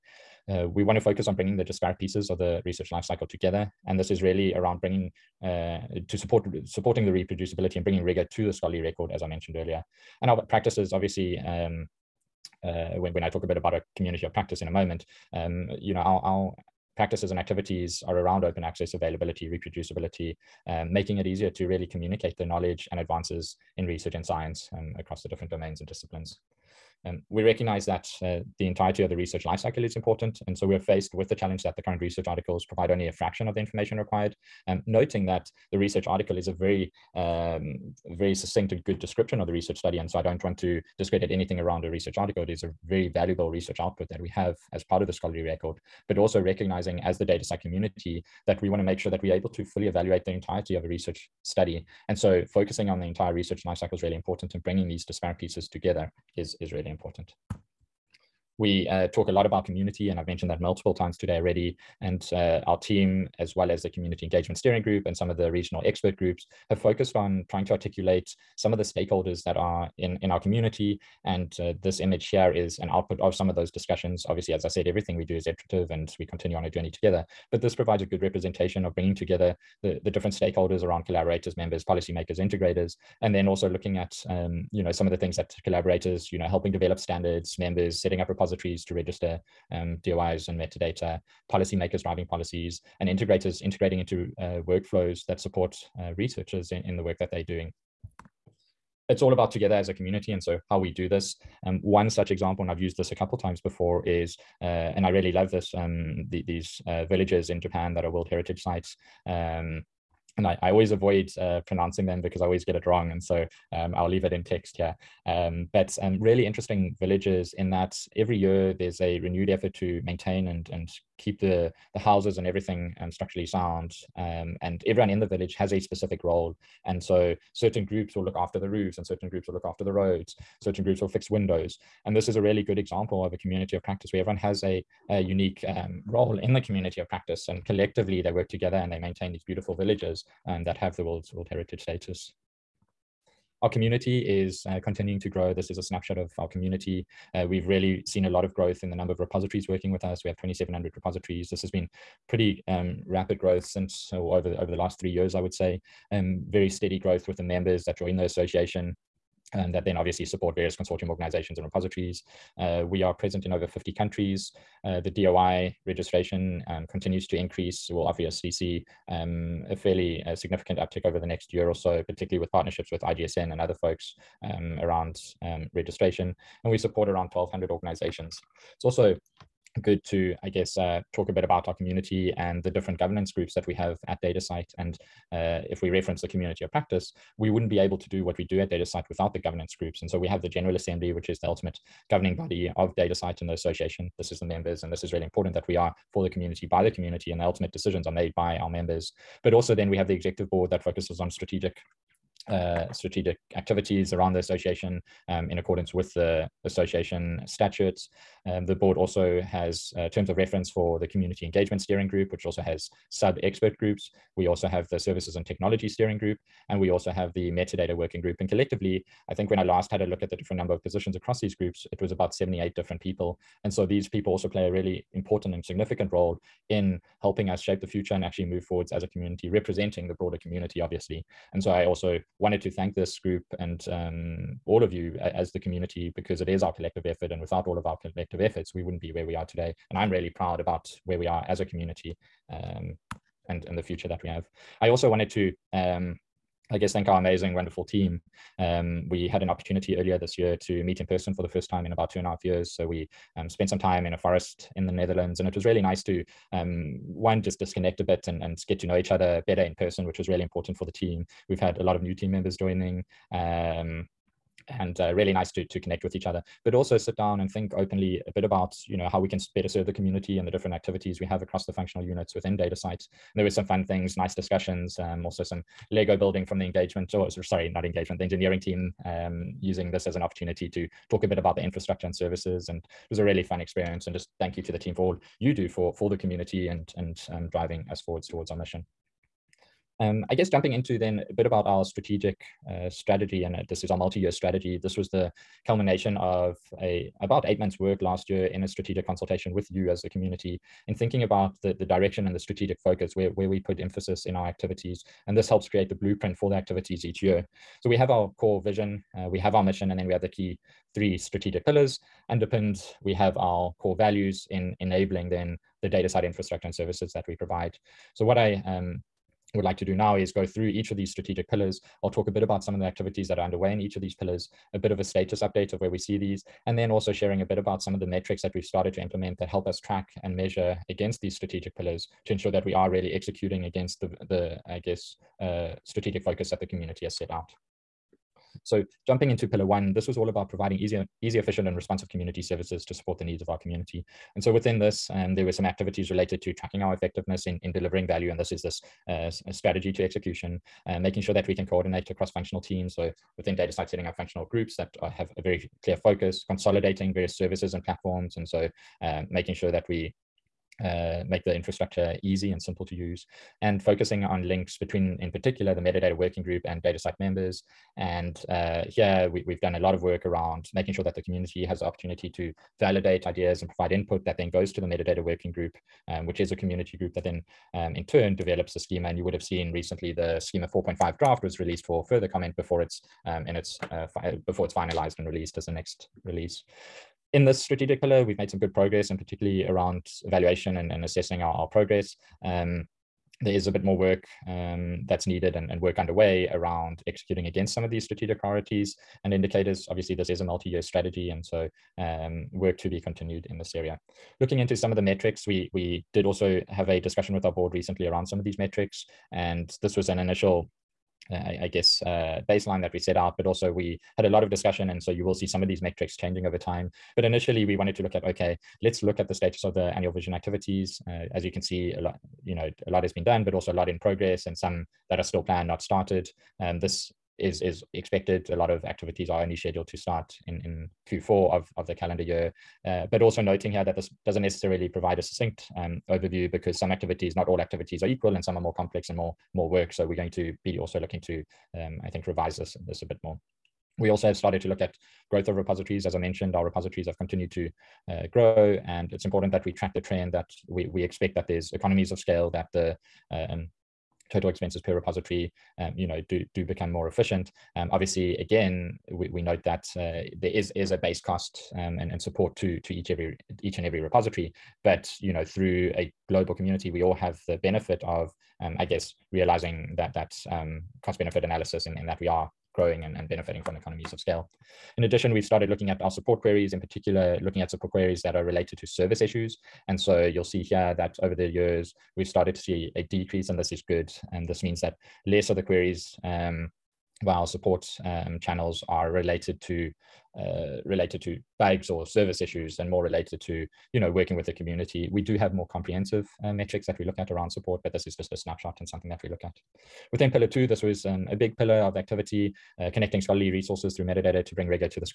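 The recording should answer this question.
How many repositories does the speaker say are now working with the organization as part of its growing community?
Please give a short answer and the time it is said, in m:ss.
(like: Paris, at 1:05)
2,700, at 2:30.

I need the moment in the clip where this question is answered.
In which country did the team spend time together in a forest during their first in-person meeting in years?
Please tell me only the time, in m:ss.
4:14.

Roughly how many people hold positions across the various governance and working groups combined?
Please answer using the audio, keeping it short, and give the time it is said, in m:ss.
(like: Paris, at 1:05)
78, at 3:42.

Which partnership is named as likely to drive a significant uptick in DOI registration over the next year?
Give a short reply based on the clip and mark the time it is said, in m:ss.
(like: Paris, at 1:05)
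IGSN, at 2:53.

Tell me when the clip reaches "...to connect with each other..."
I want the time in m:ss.
4:25.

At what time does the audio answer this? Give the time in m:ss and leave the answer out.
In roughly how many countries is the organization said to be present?
2:43.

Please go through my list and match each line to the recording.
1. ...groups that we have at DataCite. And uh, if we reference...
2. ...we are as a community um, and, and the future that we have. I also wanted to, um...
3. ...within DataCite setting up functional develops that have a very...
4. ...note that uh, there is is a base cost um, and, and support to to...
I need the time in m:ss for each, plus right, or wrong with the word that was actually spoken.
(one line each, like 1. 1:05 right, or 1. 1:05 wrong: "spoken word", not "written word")
1. 3:03 right
2. 4:01 right
3. 5:53 wrong: "groups", not "develops"
4. 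7:39 right.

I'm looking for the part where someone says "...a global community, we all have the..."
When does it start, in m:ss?
7:45.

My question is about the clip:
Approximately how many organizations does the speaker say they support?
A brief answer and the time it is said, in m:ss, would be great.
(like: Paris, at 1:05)
1,200, at 2:57.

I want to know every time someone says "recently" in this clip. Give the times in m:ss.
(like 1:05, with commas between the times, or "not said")
6:19, 6:47.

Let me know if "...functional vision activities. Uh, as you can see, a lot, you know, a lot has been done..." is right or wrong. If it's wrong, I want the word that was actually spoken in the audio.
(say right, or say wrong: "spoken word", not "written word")
wrong: "annual", not "functional".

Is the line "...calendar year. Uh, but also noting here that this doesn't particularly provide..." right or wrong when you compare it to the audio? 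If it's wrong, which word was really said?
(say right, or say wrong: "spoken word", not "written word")
wrong: "necessarily", not "particularly".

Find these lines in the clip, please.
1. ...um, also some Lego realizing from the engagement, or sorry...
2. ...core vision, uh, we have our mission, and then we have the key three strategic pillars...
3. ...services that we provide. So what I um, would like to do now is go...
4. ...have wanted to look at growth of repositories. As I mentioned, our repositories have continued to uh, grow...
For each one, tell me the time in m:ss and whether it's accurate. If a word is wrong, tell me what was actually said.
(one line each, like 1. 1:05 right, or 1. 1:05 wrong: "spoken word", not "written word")
1. 4:34 wrong: "building", not "realizing"
2. 5:08 right
3. 5:16 right
4. 7:24 wrong: "started", not "wanted".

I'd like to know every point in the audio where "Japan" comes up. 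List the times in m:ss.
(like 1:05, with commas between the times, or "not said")
1:47.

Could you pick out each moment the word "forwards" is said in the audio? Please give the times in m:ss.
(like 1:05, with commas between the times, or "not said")
3:48, 4:47.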